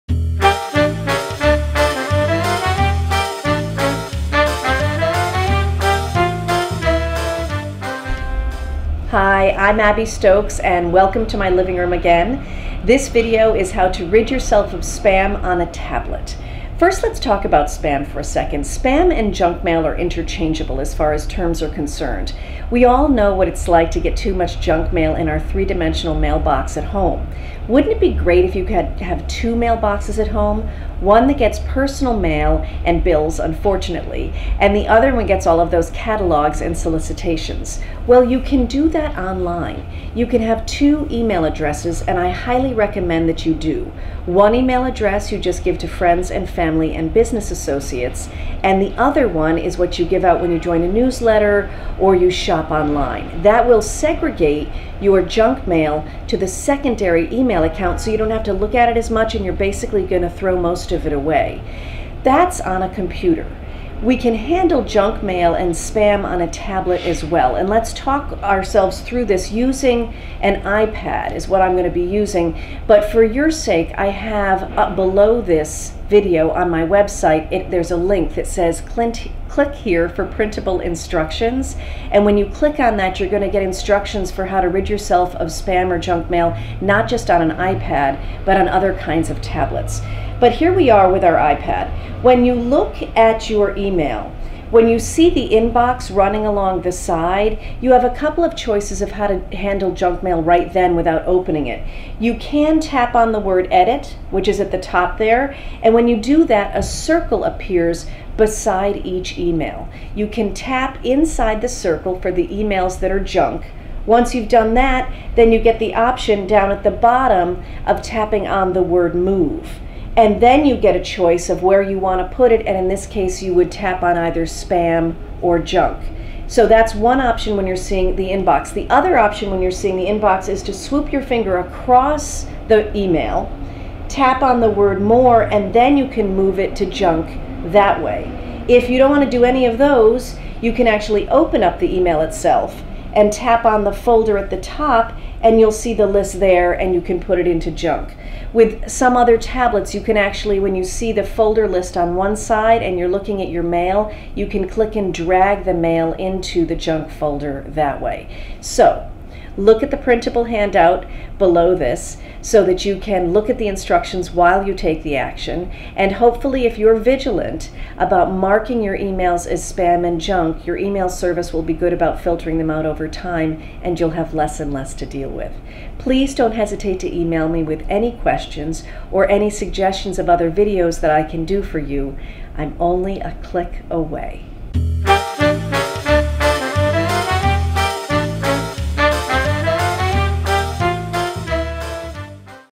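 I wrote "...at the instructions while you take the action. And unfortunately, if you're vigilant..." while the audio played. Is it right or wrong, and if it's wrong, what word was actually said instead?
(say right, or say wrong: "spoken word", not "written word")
wrong: "hopefully", not "unfortunately".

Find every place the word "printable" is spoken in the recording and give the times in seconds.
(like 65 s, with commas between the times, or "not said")
80 s, 159 s.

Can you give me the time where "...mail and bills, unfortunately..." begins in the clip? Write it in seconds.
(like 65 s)
32 s.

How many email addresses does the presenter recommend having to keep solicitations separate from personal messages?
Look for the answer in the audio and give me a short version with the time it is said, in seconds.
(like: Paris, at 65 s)
2, at 40 s.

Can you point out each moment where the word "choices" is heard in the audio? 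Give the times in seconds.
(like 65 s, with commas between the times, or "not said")
98 s, 121 s.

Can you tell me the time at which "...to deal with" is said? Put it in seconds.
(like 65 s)
174 s.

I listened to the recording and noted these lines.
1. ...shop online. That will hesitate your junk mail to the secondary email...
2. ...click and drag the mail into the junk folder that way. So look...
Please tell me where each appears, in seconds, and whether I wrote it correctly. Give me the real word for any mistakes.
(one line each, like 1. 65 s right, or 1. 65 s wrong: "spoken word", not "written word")
1. 52 s wrong: "segregate", not "hesitate"
2. 154 s right.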